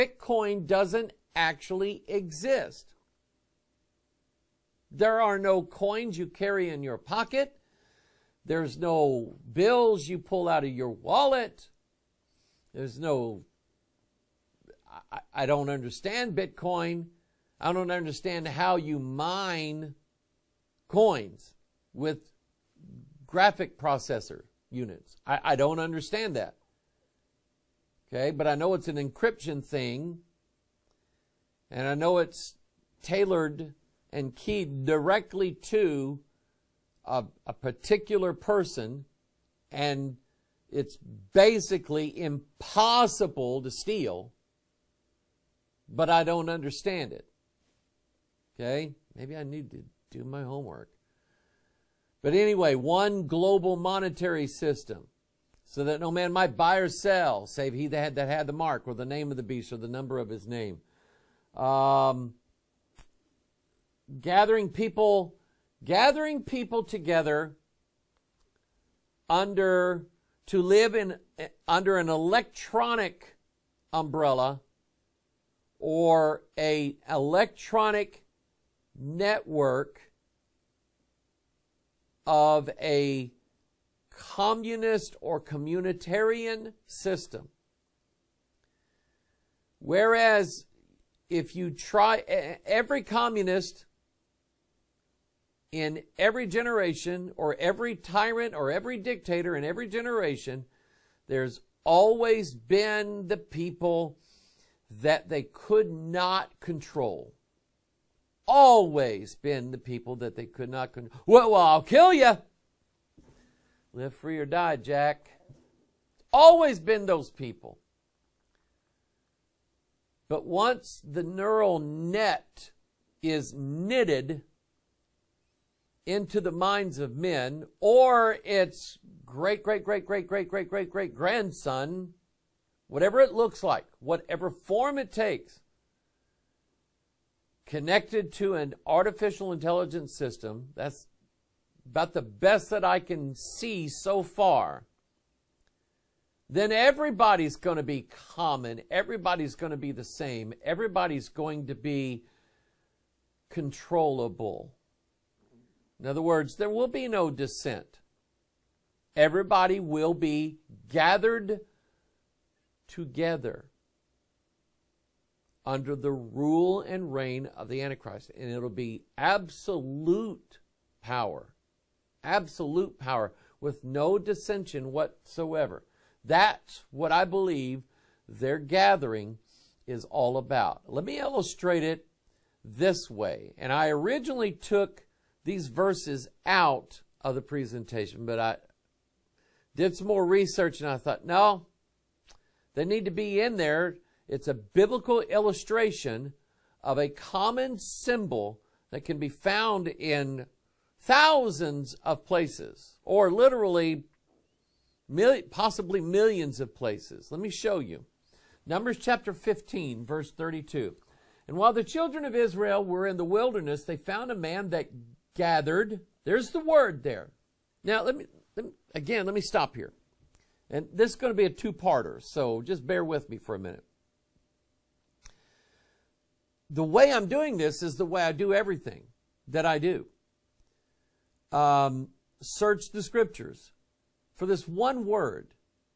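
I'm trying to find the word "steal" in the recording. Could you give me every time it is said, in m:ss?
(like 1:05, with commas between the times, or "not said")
0:43.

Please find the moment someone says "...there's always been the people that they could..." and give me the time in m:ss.
1:41.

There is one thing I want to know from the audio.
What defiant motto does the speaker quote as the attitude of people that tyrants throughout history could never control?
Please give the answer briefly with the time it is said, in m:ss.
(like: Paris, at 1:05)
Live free or die, at 1:53.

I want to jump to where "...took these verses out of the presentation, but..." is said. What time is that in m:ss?
3:04.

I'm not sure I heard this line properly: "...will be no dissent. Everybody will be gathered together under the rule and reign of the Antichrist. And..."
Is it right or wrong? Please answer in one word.
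right.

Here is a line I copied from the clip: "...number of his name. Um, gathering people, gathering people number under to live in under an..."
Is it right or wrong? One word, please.
wrong.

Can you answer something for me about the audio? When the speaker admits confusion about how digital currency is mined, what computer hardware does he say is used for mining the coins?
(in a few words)
Graphic processor units.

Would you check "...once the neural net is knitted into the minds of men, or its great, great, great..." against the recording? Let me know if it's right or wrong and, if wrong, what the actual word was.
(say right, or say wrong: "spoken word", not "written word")
right.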